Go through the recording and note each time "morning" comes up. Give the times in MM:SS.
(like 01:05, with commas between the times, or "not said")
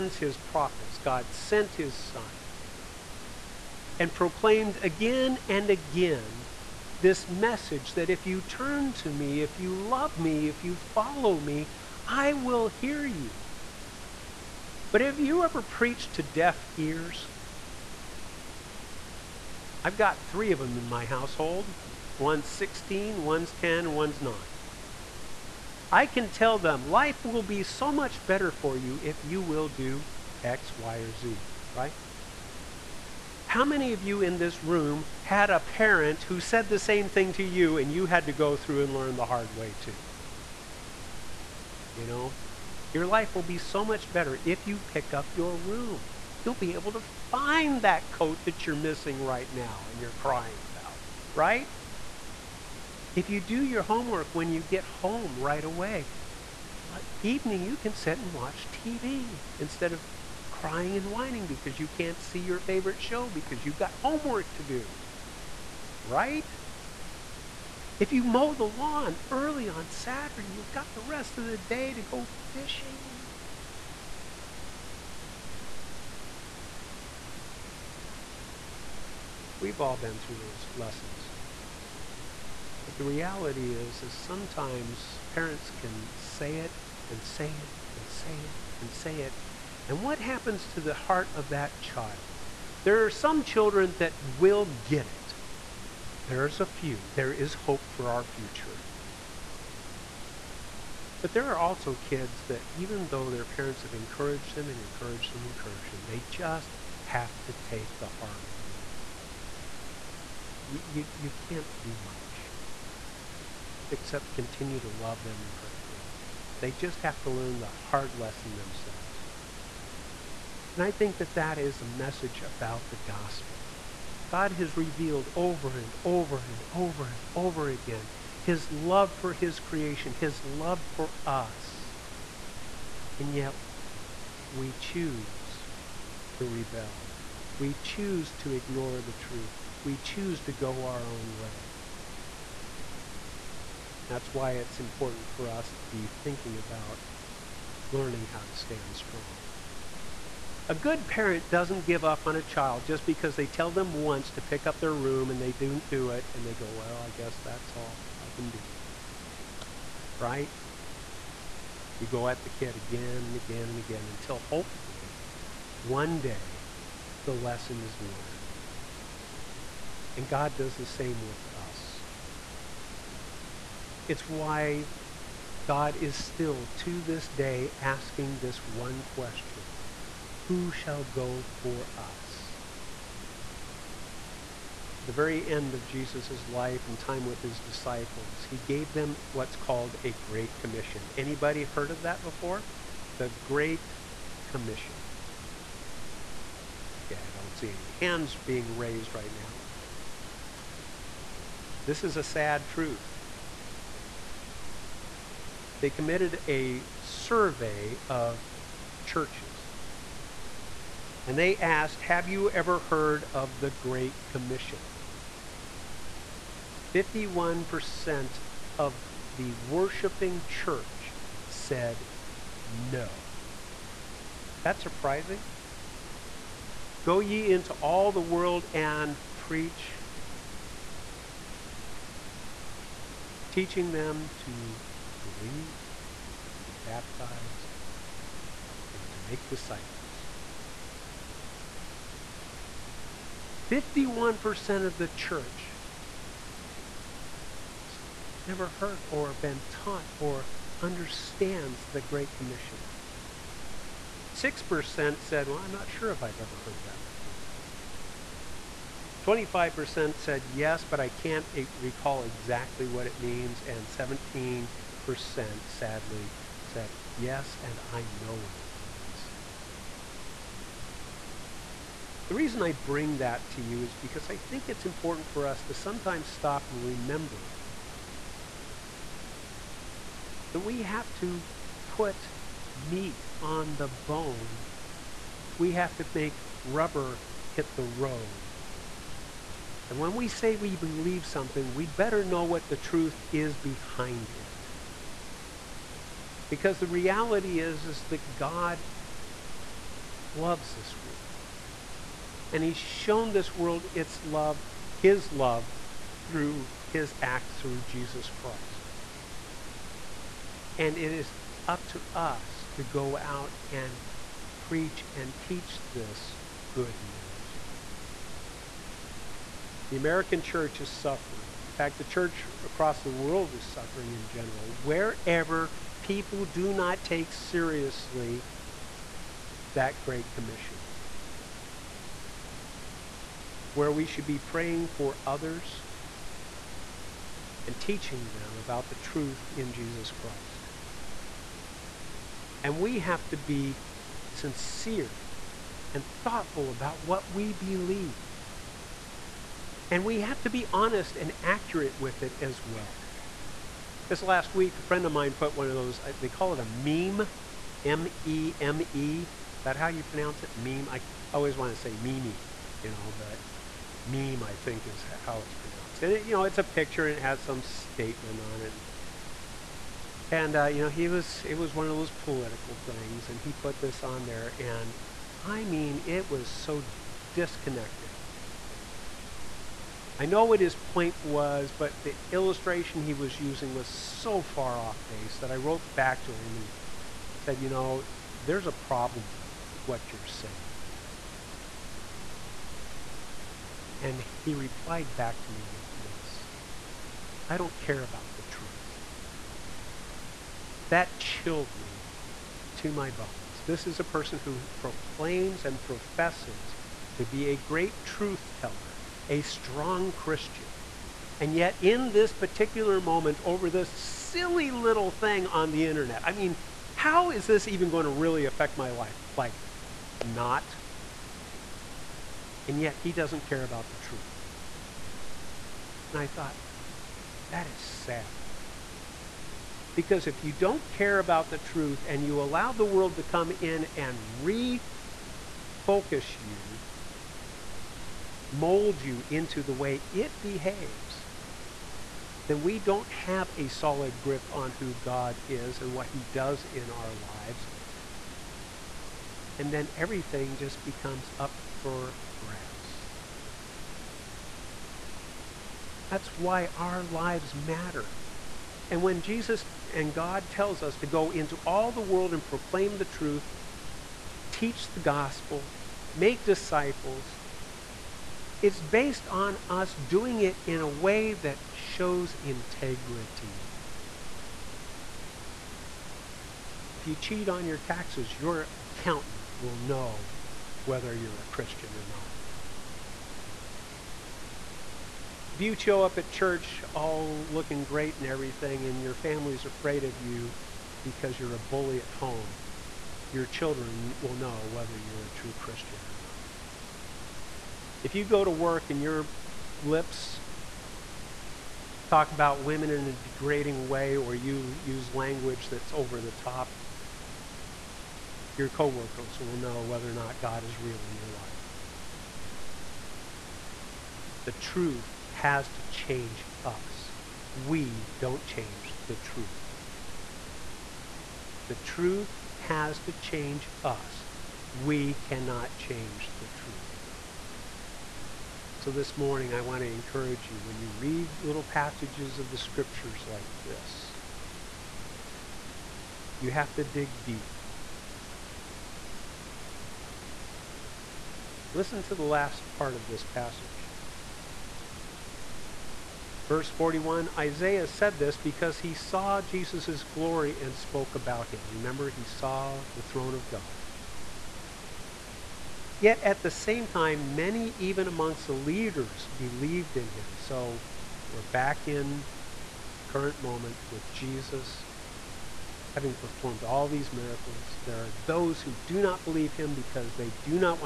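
08:49.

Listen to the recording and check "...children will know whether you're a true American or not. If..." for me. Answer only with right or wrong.
wrong.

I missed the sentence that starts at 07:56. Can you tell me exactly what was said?
If you cheat on your taxes, your accountant will know whether you're a Christian or not.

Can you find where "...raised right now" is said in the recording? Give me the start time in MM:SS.
03:18.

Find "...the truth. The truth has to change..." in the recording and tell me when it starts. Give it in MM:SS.
08:39.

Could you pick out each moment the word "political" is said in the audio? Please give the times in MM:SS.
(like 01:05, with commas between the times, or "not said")
06:12.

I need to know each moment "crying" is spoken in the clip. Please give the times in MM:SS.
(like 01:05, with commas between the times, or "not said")
00:50, 01:00.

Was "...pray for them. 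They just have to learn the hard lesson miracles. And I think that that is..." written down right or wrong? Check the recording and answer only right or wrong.
wrong.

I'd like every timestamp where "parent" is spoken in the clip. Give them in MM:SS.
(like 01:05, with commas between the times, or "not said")
00:35, 01:25, 01:43, 02:31.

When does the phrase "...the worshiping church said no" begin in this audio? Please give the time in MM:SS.
03:39.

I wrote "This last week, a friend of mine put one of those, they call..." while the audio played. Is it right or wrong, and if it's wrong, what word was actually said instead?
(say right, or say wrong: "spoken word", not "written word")
right.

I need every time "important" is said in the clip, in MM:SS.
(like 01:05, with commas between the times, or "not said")
02:24, 04:34.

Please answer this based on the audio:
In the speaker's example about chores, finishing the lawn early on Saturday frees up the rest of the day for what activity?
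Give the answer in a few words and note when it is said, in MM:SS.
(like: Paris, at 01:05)
fishing, at 01:12.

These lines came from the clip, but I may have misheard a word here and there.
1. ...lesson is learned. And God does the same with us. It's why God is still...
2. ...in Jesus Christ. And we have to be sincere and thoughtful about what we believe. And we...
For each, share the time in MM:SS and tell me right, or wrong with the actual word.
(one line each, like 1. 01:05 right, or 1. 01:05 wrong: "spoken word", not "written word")
1. 02:47 right
2. 05:39 right.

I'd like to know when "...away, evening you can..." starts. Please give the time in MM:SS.
00:55.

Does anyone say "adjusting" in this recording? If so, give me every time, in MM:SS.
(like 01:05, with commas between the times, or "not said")
not said.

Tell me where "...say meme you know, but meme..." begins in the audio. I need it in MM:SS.
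06:01.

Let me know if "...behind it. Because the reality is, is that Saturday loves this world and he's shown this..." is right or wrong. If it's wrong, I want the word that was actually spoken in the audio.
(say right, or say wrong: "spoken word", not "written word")
wrong: "God", not "Saturday".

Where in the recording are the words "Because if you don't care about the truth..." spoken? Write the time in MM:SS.
07:09.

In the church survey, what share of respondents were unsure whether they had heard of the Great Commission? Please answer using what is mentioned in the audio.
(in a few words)
6%.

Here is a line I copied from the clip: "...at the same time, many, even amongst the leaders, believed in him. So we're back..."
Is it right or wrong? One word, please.
right.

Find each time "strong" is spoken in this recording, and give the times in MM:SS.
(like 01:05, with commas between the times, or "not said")
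02:28, 06:49.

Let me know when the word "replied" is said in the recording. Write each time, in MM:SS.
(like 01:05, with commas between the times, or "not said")
06:34.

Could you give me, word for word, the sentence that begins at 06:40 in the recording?
That chilled me to my bones.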